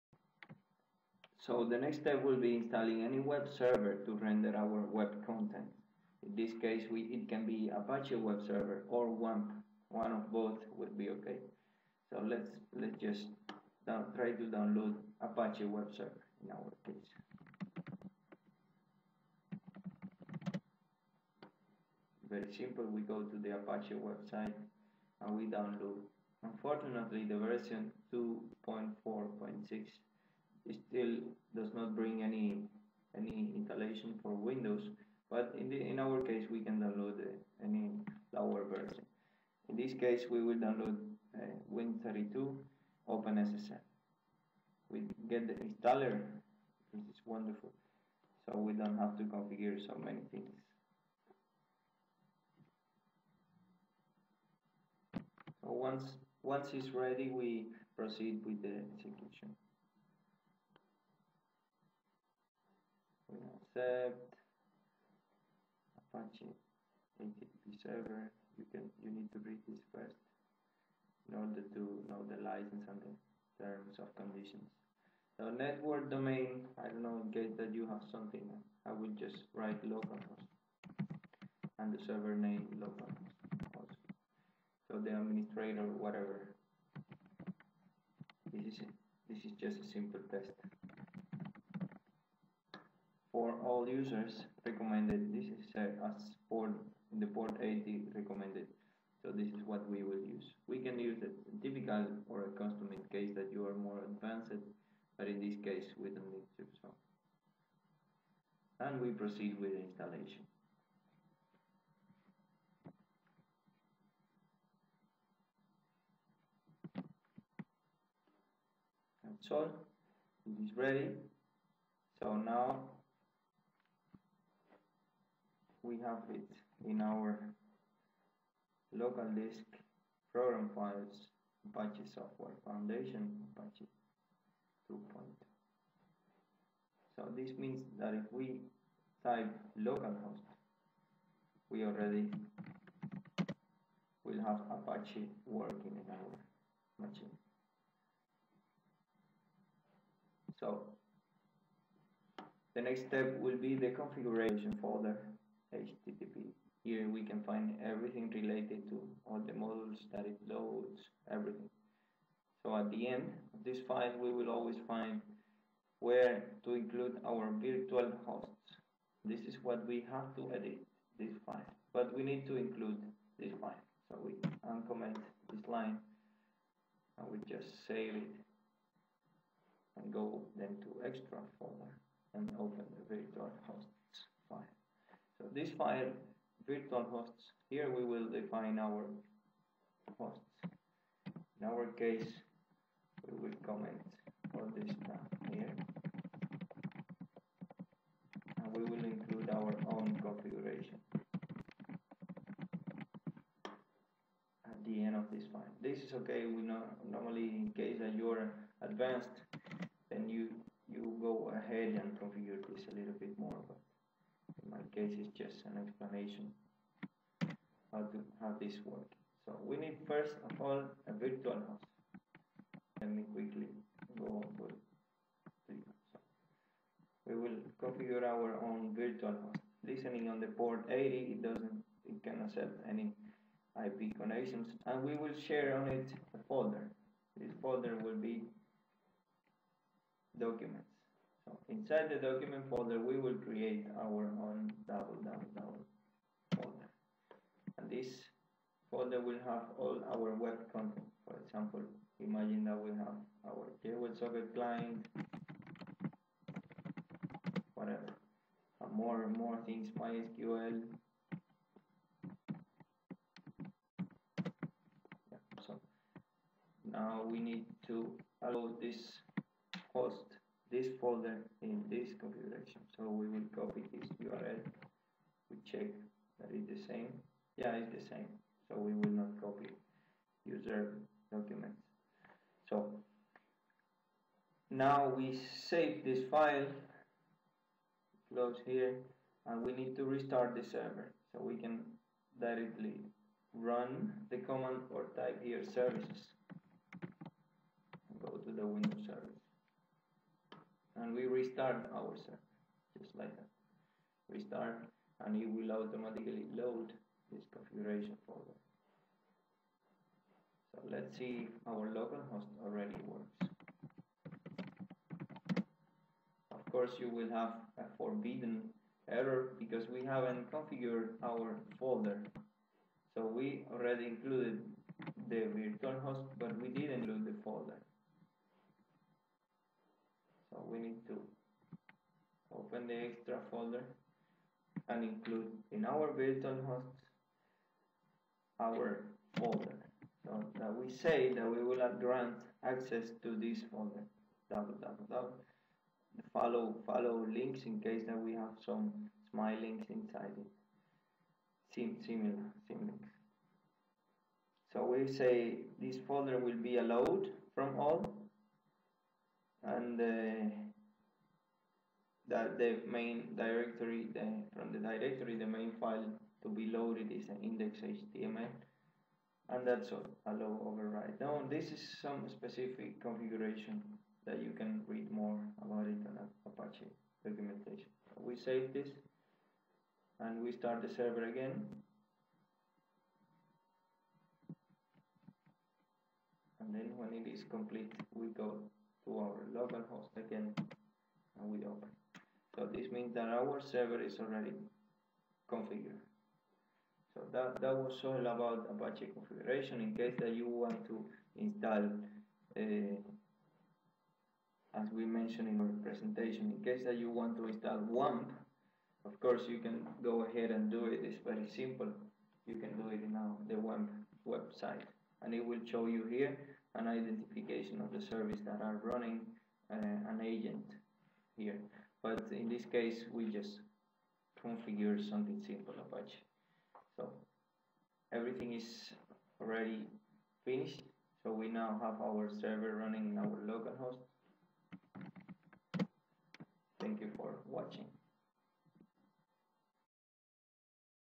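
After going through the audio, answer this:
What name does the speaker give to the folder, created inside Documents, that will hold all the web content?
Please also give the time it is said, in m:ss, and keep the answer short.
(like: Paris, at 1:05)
double double double, at 4:04.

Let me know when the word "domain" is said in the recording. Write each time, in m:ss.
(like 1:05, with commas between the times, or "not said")
1:16.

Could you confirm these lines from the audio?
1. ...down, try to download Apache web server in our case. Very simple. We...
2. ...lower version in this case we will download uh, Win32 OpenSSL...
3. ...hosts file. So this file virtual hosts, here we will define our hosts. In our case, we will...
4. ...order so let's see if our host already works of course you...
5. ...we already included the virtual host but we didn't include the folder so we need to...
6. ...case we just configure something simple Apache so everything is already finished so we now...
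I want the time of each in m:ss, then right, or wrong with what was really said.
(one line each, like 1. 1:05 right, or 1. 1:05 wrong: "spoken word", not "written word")
1. 0:13 right
2. 0:38 right
3. 3:03 right
4. 5:08 wrong: "folder", not "order"
5. 5:23 right
6. 7:02 right.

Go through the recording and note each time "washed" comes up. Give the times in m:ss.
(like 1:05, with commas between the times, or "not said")
not said.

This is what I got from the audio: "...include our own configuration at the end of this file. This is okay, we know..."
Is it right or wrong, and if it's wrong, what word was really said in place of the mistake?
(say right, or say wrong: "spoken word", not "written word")
right.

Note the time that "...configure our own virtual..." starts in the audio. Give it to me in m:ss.
3:47.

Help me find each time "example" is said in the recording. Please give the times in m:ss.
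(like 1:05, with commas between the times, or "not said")
4:11.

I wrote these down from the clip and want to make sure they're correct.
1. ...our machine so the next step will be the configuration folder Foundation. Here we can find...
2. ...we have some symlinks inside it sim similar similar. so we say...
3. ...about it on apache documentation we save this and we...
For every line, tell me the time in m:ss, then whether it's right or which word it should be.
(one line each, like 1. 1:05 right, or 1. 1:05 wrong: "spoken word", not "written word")
1. 2:26 wrong: "HTTP", not "Foundation"
2. 5:48 right
3. 6:15 right.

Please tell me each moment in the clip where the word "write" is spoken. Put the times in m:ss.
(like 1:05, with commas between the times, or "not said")
1:19.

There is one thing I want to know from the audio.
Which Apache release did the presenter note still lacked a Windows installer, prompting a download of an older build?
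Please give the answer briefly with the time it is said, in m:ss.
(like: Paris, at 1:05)
2.4.6, at 0:28.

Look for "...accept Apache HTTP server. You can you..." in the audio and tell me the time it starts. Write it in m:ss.
1:03.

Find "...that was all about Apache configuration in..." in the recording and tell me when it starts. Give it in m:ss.
6:37.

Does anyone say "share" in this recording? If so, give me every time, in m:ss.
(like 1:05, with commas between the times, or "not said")
3:55.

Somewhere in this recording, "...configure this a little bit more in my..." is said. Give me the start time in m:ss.
3:32.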